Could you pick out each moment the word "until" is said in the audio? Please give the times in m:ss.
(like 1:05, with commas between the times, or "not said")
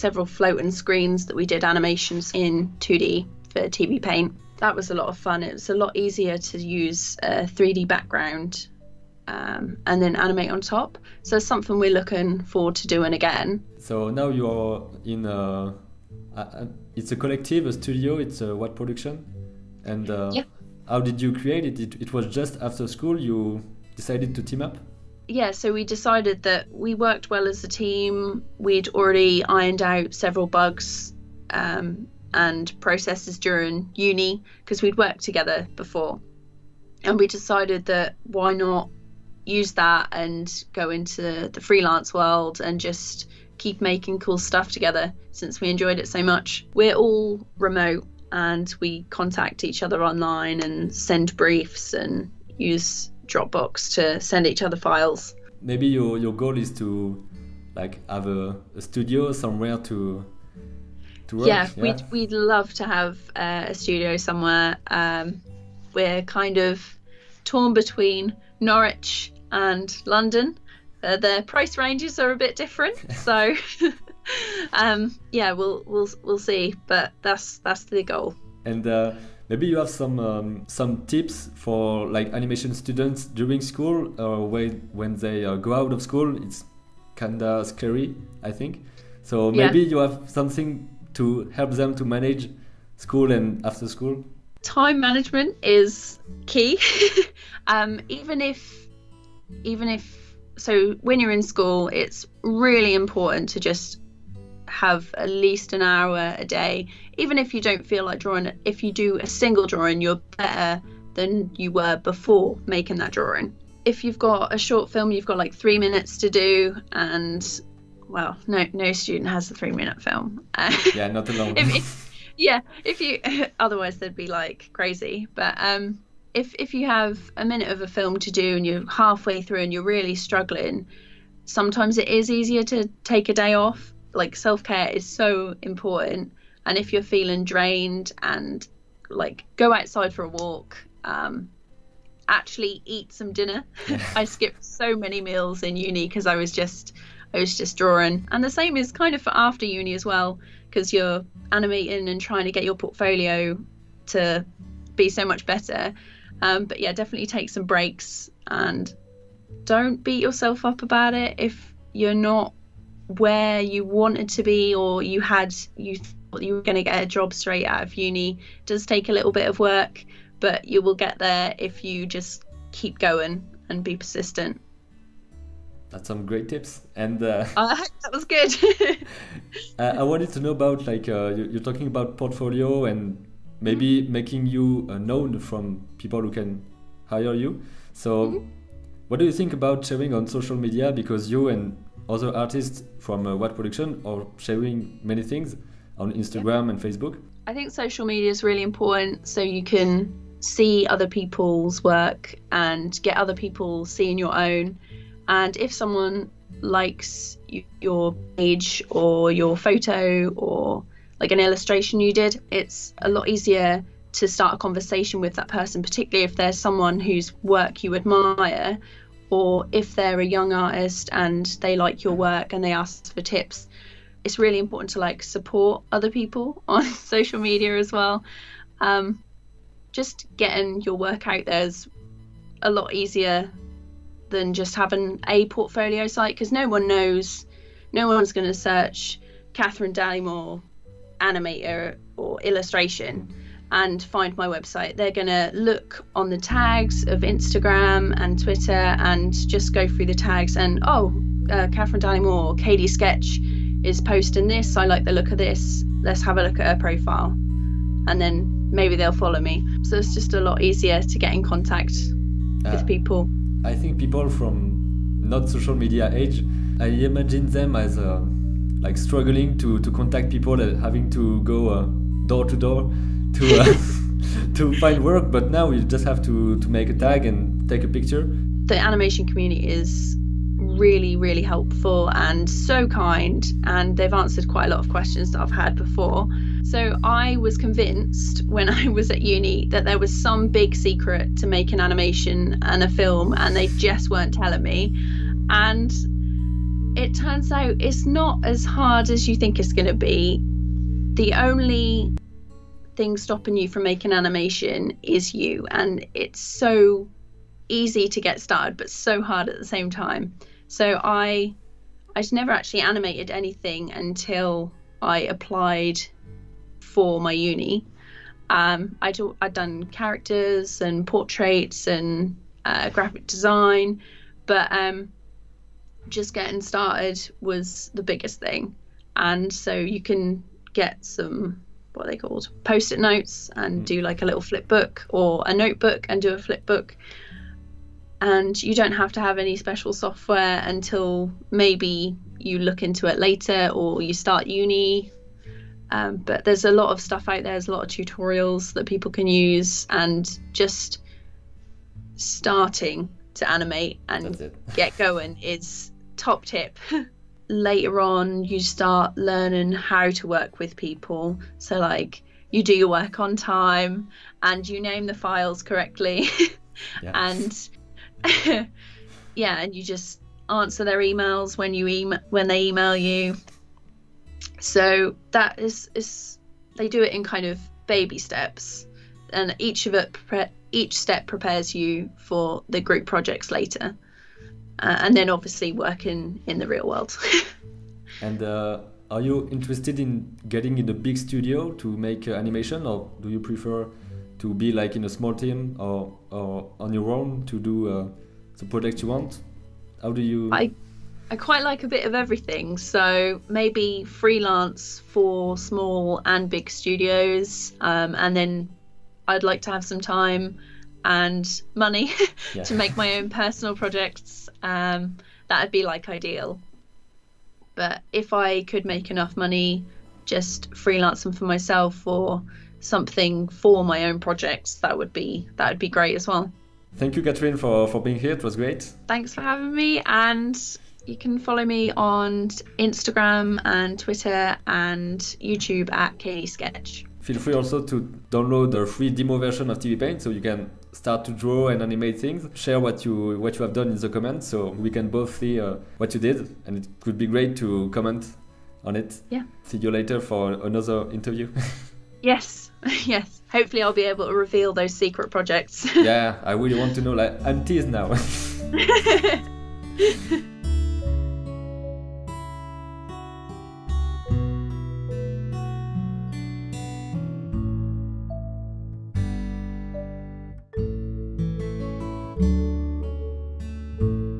5:13, 5:40.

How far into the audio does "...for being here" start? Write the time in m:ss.
7:07.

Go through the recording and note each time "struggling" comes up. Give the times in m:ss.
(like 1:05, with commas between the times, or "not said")
2:10, 4:28.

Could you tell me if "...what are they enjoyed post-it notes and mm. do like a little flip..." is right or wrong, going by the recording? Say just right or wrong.
wrong.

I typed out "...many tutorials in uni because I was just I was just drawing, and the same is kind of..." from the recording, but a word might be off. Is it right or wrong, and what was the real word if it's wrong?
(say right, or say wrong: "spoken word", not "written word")
wrong: "meals", not "tutorials".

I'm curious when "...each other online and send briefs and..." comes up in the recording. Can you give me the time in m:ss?
0:49.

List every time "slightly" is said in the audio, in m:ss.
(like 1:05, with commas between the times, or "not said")
not said.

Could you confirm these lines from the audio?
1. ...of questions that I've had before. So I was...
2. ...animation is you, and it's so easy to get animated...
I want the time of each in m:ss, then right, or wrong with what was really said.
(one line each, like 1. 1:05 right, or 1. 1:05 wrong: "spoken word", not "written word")
1. 4:44 right
2. 5:04 wrong: "started", not "animated".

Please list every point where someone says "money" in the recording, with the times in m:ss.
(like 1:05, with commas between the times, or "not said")
6:51, 6:59.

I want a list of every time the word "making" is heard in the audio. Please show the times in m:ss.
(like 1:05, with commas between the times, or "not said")
0:43, 1:52, 3:04, 5:03.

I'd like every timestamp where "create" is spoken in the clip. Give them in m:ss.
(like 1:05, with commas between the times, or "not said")
0:21.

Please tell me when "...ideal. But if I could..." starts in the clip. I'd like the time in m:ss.
6:56.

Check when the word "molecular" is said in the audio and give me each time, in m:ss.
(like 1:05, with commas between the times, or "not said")
not said.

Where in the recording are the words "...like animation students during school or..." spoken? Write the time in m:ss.
1:22.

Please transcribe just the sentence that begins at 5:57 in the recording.
Later on, you start learning how to work with people.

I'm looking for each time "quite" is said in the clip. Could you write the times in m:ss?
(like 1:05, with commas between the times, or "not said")
4:44, 6:41.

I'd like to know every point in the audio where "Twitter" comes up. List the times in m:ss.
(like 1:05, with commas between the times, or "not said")
4:08, 7:13.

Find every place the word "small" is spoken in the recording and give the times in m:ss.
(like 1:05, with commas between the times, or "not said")
6:35, 6:45.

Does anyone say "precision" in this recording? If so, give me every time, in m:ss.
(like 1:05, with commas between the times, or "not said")
not said.